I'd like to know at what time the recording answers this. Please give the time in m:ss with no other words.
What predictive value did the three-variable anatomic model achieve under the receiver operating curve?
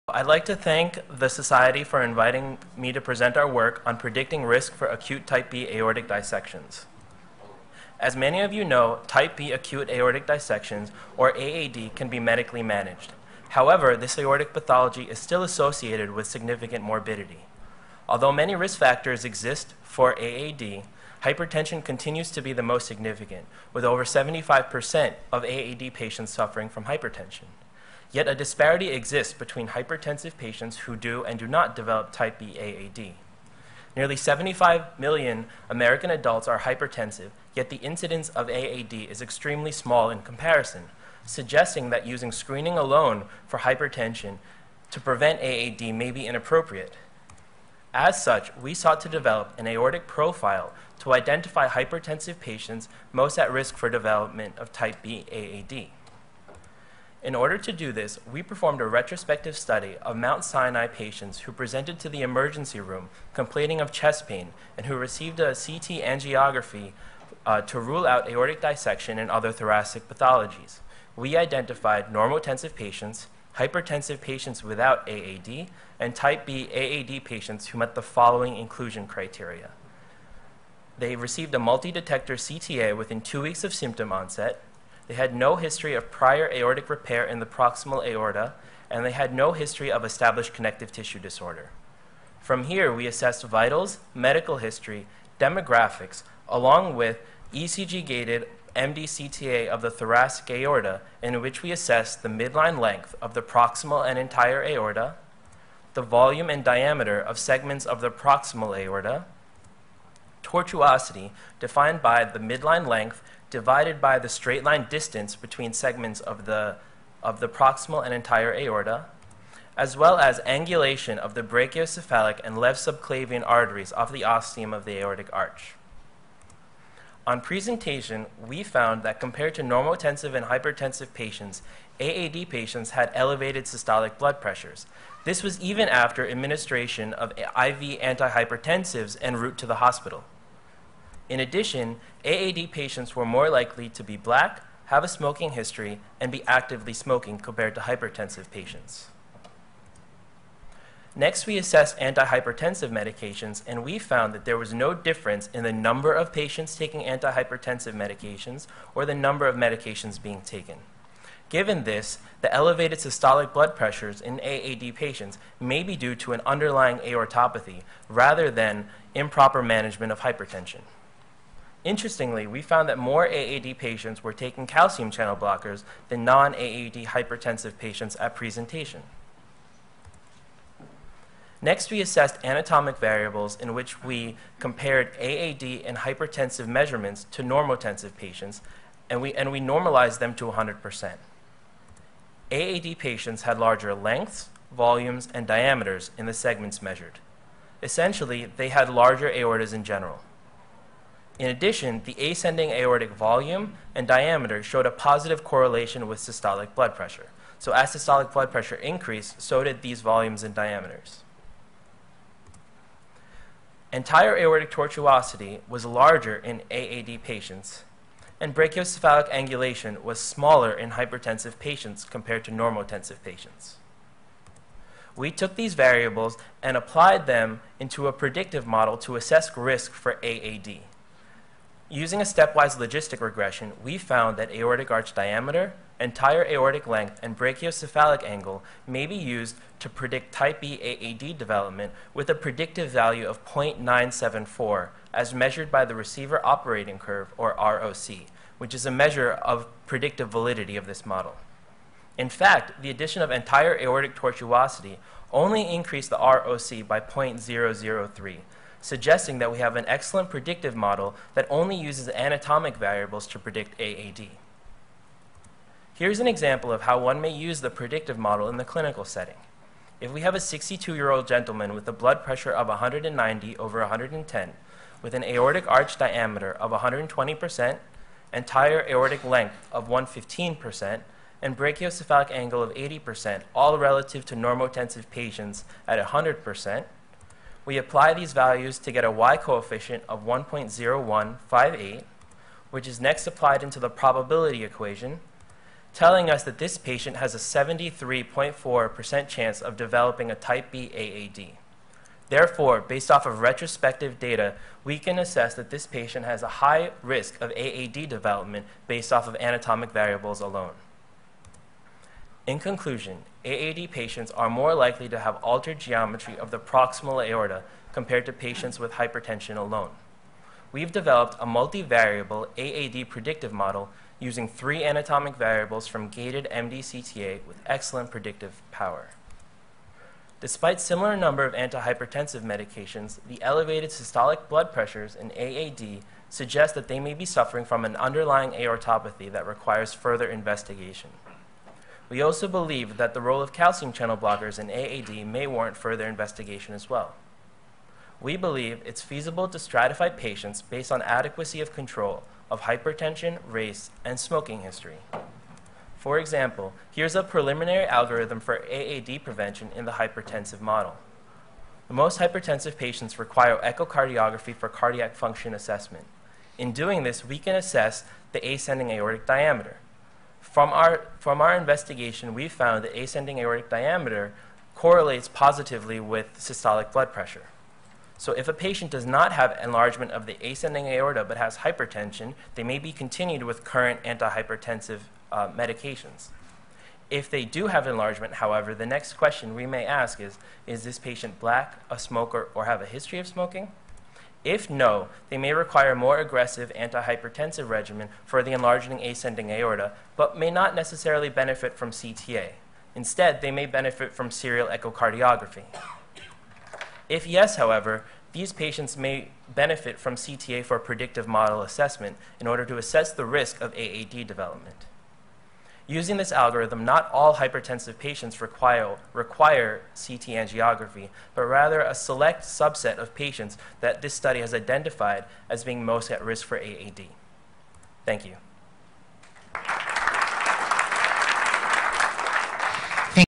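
4:03.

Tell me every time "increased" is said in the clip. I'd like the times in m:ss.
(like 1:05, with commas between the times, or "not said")
3:28, 4:15.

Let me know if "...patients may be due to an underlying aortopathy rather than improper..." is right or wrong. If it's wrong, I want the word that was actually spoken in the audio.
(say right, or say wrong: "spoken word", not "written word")
right.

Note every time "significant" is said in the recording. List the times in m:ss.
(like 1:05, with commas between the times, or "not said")
0:16, 0:22.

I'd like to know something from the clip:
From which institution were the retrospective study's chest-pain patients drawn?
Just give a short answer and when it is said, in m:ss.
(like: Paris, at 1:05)
Mount Sinai, at 1:00.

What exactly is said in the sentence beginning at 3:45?
We took these variables and applied them into a predictive model to assess risk for AAD.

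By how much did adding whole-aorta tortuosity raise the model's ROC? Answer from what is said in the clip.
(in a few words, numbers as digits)
0.003.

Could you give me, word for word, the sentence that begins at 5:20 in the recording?
We've developed a multivariable AAD predictive model using three anatomic variables from gated MDCTA with excellent predictive power.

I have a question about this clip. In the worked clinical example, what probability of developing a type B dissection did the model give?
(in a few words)
73.4%.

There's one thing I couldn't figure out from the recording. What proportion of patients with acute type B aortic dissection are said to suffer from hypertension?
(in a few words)
over 75%.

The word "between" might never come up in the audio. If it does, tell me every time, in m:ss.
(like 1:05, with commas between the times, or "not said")
0:29, 1:55.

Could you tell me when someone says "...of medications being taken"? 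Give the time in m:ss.
2:39.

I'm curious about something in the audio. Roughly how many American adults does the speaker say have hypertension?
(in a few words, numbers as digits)
75 million.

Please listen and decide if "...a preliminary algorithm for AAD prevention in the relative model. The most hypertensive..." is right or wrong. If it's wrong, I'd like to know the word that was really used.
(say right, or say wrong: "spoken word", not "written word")
wrong: "hypertensive", not "relative".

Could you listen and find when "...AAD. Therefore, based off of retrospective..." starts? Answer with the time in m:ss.
5:00.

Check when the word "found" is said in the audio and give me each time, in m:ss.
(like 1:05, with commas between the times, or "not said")
2:08, 2:33, 2:52, 3:53, 6:12.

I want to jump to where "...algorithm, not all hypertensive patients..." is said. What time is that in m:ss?
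6:56.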